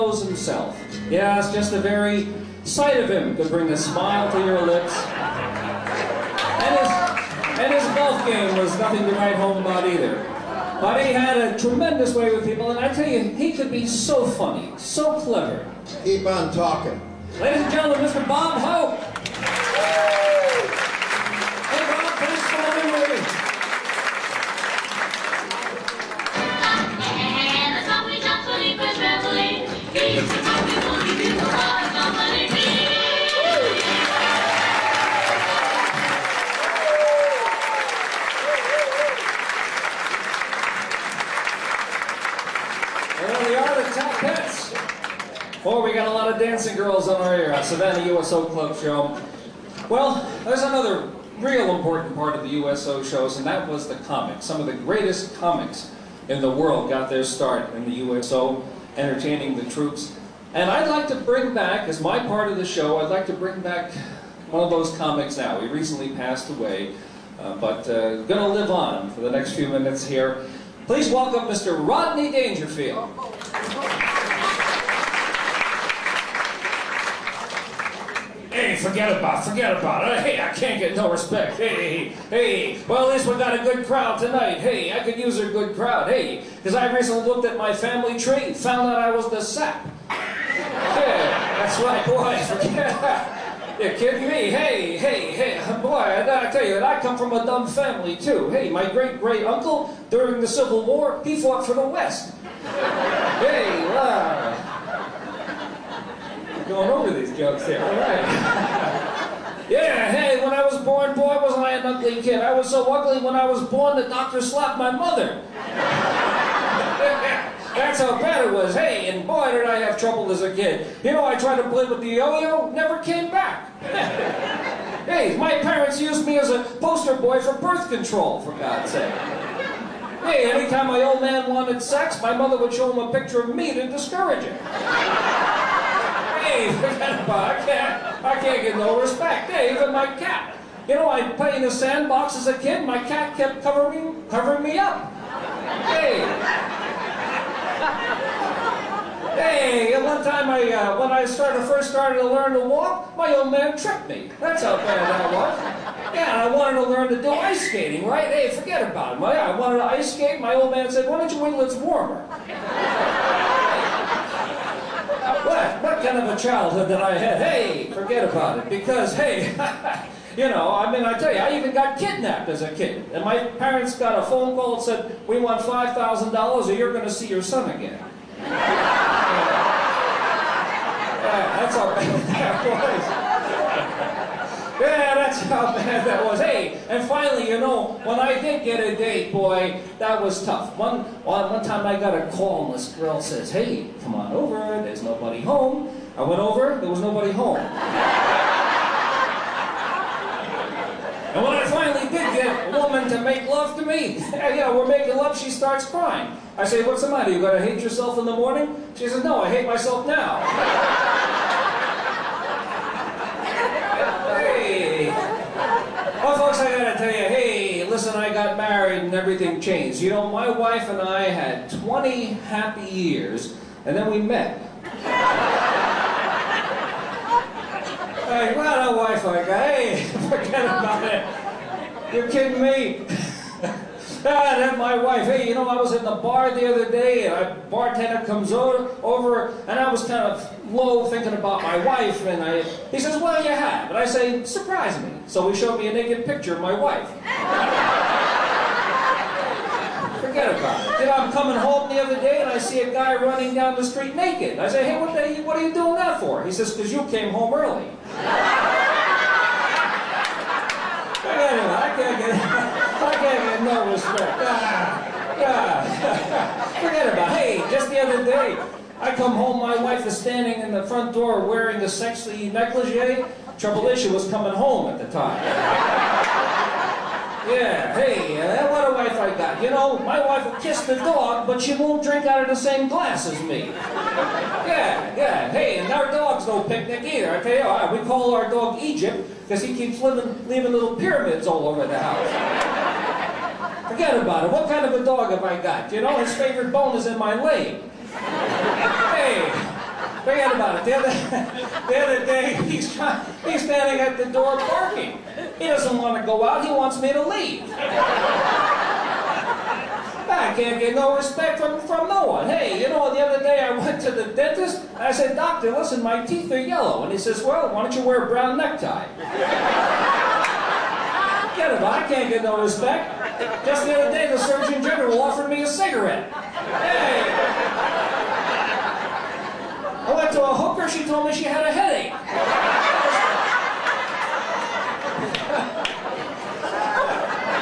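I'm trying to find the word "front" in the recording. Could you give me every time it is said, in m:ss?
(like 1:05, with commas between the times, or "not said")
4:30.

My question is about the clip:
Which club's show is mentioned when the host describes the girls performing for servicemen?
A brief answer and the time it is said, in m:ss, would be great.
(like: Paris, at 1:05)
Savannah USO Club, at 0:47.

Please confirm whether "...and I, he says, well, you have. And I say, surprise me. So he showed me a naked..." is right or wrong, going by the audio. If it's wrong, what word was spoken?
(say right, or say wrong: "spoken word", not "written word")
right.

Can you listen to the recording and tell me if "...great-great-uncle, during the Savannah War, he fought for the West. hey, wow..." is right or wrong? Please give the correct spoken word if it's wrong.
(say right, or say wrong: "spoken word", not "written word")
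wrong: "Civil", not "Savannah".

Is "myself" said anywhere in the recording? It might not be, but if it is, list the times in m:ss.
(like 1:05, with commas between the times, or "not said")
3:29.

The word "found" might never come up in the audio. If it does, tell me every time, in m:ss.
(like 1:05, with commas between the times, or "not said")
1:28.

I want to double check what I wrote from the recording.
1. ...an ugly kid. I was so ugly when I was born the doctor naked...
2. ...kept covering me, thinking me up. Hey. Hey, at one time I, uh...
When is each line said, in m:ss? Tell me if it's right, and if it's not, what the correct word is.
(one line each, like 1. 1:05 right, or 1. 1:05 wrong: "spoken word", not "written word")
1. 1:51 wrong: "slapped", not "naked"
2. 2:23 wrong: "covering", not "thinking".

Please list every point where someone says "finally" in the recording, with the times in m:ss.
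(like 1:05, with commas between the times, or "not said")
3:07, 3:21.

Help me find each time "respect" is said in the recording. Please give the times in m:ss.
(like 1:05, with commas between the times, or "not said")
1:21, 2:19, 4:23, 5:11, 5:22.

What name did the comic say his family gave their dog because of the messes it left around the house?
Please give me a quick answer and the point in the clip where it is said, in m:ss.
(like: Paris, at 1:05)
Egypt, at 4:48.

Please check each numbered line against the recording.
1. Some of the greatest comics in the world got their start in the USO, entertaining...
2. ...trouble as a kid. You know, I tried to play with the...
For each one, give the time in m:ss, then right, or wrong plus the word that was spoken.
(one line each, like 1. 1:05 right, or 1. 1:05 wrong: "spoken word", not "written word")
1. 0:54 right
2. 1:59 right.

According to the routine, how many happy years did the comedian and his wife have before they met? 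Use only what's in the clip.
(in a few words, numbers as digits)
20.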